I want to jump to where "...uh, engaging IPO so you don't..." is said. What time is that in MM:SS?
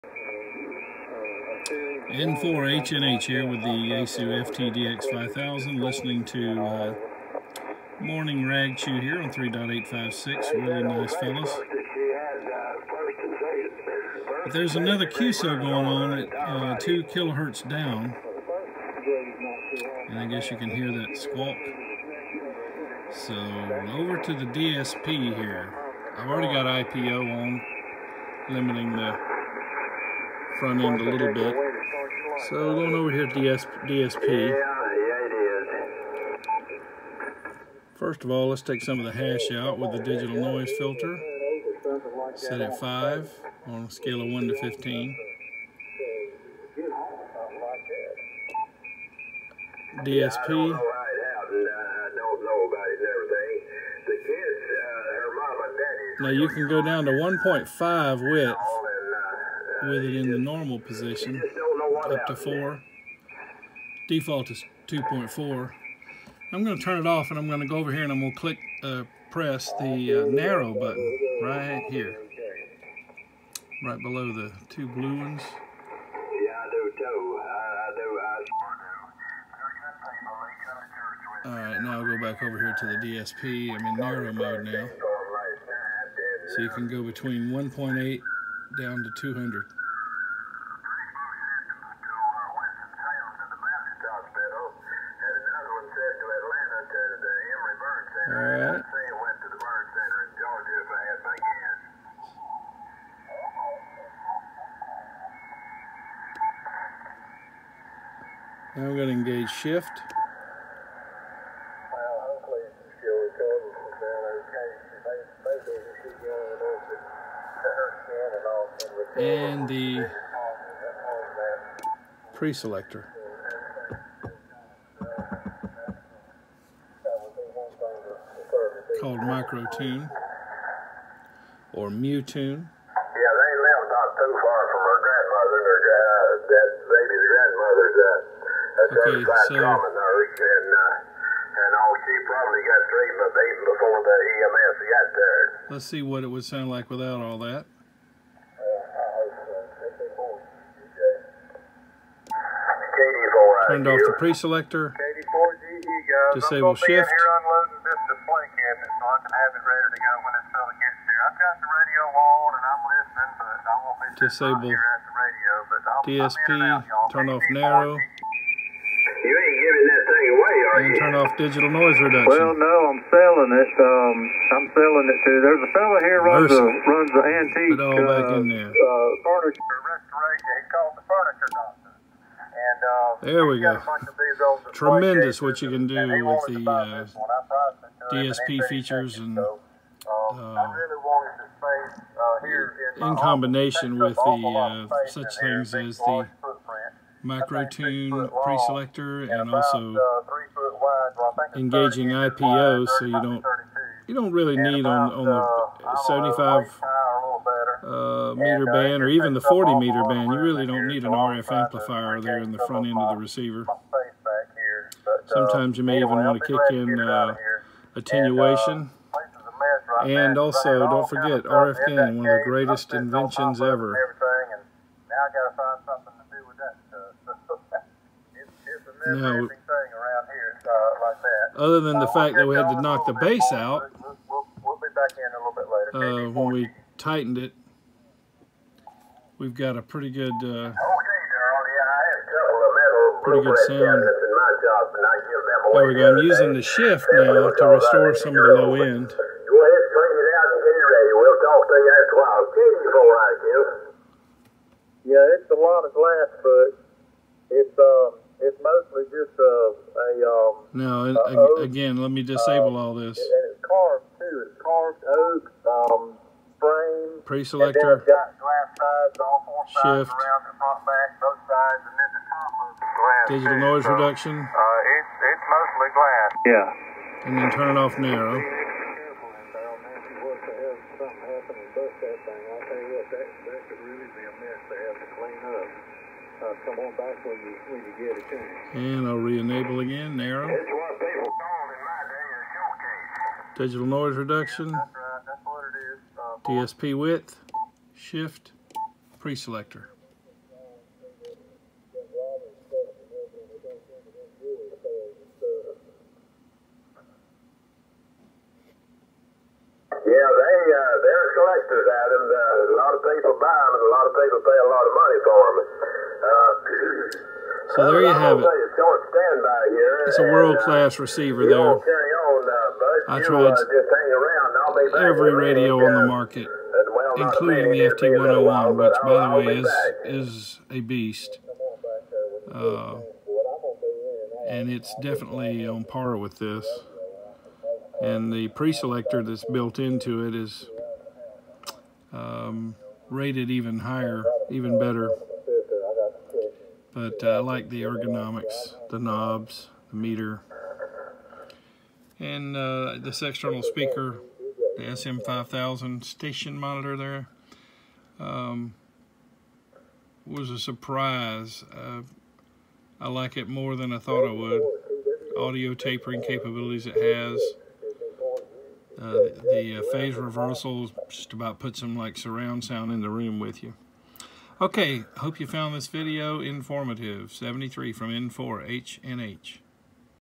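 03:19.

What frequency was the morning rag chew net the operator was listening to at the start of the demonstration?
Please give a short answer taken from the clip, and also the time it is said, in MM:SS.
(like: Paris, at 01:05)
3.856, at 00:09.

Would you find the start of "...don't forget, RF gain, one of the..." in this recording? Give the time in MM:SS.
03:40.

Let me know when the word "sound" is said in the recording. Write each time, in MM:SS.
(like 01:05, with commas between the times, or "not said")
02:26, 04:03, 06:12.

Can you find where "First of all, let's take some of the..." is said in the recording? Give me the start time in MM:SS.
00:37.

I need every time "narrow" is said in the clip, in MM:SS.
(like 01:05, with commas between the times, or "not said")
01:10, 01:23, 02:47.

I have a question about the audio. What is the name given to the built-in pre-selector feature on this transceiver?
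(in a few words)
Micro Tune.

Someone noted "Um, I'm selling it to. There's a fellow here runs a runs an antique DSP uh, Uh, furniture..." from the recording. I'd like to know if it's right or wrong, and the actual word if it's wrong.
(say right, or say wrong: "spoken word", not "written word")
wrong: "Put", not "DSP".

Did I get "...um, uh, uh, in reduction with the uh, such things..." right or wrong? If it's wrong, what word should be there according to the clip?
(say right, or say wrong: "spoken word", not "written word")
wrong: "combination", not "reduction".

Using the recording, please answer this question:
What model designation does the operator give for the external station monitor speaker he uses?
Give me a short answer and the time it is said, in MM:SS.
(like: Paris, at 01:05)
SM5000, at 05:54.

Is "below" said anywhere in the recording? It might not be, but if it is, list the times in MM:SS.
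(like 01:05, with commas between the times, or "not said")
01:13.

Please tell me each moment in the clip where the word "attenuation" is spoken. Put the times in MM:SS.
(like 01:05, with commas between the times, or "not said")
03:37.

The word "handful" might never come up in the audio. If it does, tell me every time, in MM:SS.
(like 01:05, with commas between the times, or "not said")
not said.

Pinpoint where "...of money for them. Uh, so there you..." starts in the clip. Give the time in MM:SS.
05:14.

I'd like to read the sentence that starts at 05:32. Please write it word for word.
Uh, and it's definitely on par with this.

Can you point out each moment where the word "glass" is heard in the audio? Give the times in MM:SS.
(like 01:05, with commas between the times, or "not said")
04:15, 04:28.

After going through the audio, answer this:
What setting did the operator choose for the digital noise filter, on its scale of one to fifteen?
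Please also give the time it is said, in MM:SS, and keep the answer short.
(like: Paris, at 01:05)
5, at 00:42.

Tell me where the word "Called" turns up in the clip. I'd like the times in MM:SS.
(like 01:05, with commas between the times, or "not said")
02:09.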